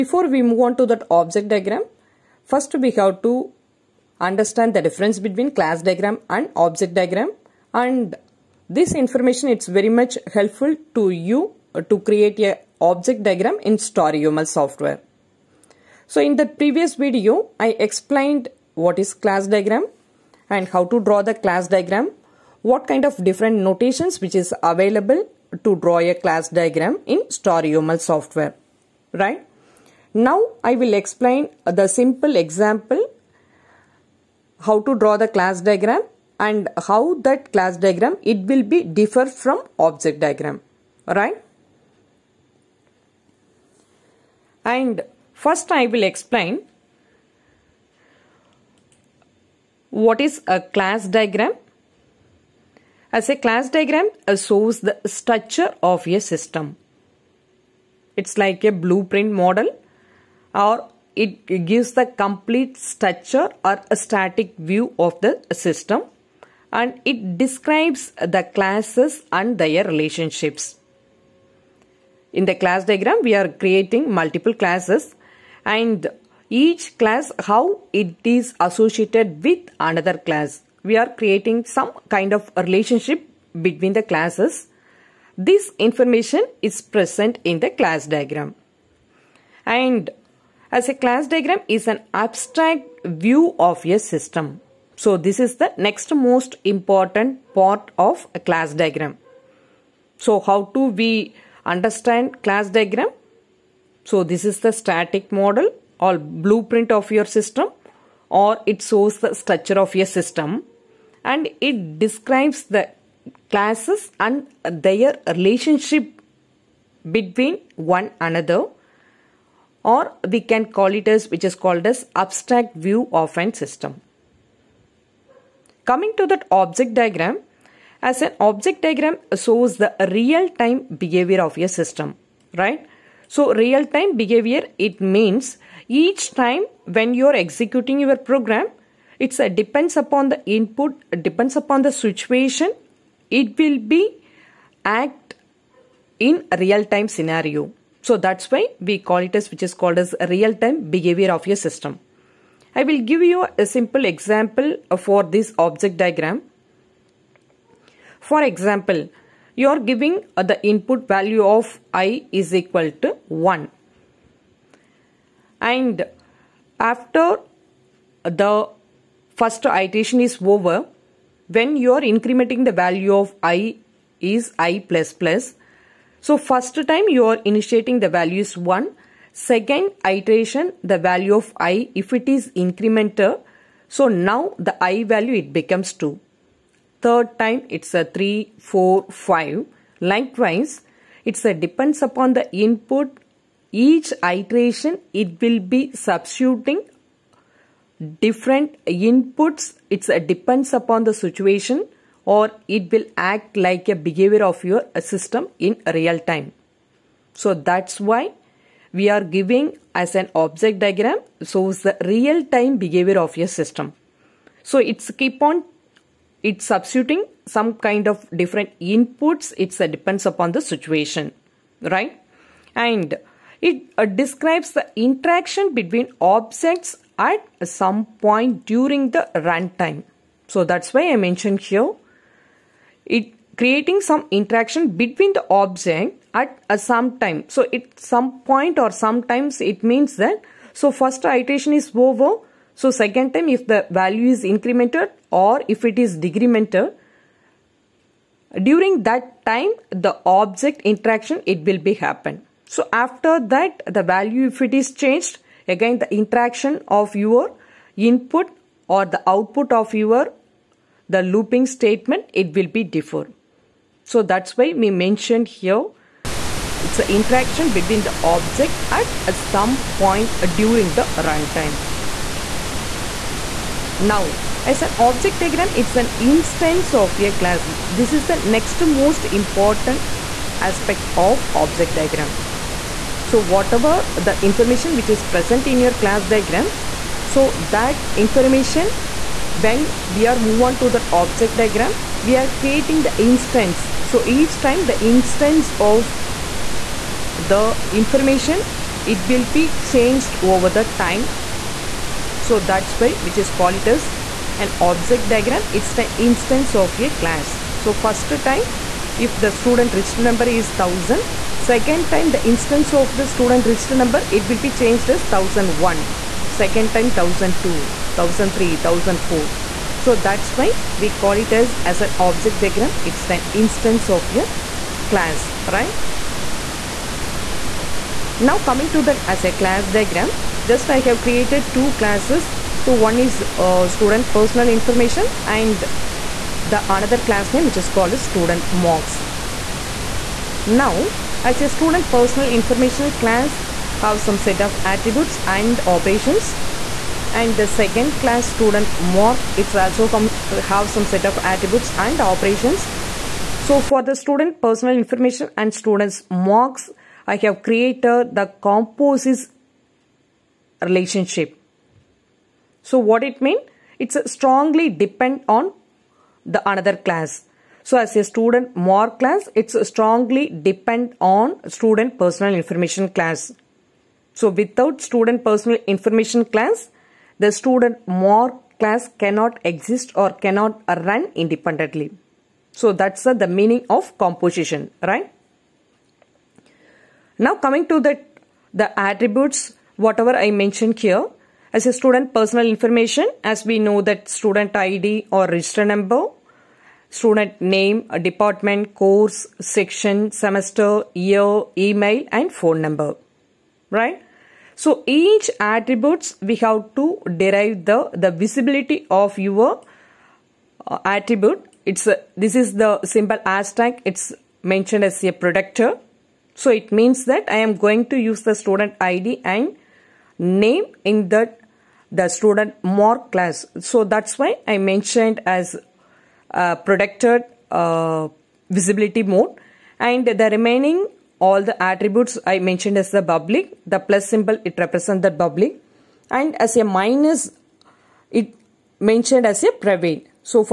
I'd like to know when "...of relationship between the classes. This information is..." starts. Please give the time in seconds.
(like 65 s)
82 s.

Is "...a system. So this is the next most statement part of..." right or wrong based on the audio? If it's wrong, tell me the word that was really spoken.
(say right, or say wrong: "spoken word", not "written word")
wrong: "important", not "statement".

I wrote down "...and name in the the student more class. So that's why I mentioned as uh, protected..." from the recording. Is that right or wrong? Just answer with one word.
right.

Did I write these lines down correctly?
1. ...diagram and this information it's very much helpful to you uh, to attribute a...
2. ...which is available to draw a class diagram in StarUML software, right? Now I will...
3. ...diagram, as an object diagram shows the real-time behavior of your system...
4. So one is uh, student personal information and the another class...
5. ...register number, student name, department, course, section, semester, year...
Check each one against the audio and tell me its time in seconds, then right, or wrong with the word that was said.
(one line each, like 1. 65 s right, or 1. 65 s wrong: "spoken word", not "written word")
1. 6 s wrong: "create", not "attribute"
2. 24 s right
3. 126 s right
4. 332 s right
5. 395 s right.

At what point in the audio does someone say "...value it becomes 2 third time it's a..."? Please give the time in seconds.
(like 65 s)
185 s.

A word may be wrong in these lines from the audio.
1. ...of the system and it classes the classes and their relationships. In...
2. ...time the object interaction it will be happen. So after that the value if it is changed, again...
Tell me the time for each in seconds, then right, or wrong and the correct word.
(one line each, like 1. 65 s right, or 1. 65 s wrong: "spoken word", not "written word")
1. 64 s wrong: "describes", not "classes"
2. 249 s right.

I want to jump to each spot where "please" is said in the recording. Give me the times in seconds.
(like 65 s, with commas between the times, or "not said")
not said.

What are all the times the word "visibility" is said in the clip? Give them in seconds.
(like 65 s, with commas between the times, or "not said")
408 s, 428 s.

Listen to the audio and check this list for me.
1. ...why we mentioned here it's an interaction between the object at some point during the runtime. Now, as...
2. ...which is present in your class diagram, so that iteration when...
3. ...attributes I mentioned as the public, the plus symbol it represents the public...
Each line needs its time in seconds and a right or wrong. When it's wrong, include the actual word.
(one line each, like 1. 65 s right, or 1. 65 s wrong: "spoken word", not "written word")
1. 264 s right
2. 284 s wrong: "information", not "iteration"
3. 431 s right.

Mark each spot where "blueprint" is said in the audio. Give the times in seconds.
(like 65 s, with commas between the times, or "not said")
58 s, 106 s.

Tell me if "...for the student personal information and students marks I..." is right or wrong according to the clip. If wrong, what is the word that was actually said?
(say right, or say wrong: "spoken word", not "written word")
right.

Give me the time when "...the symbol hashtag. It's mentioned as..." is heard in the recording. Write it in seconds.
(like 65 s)
412 s.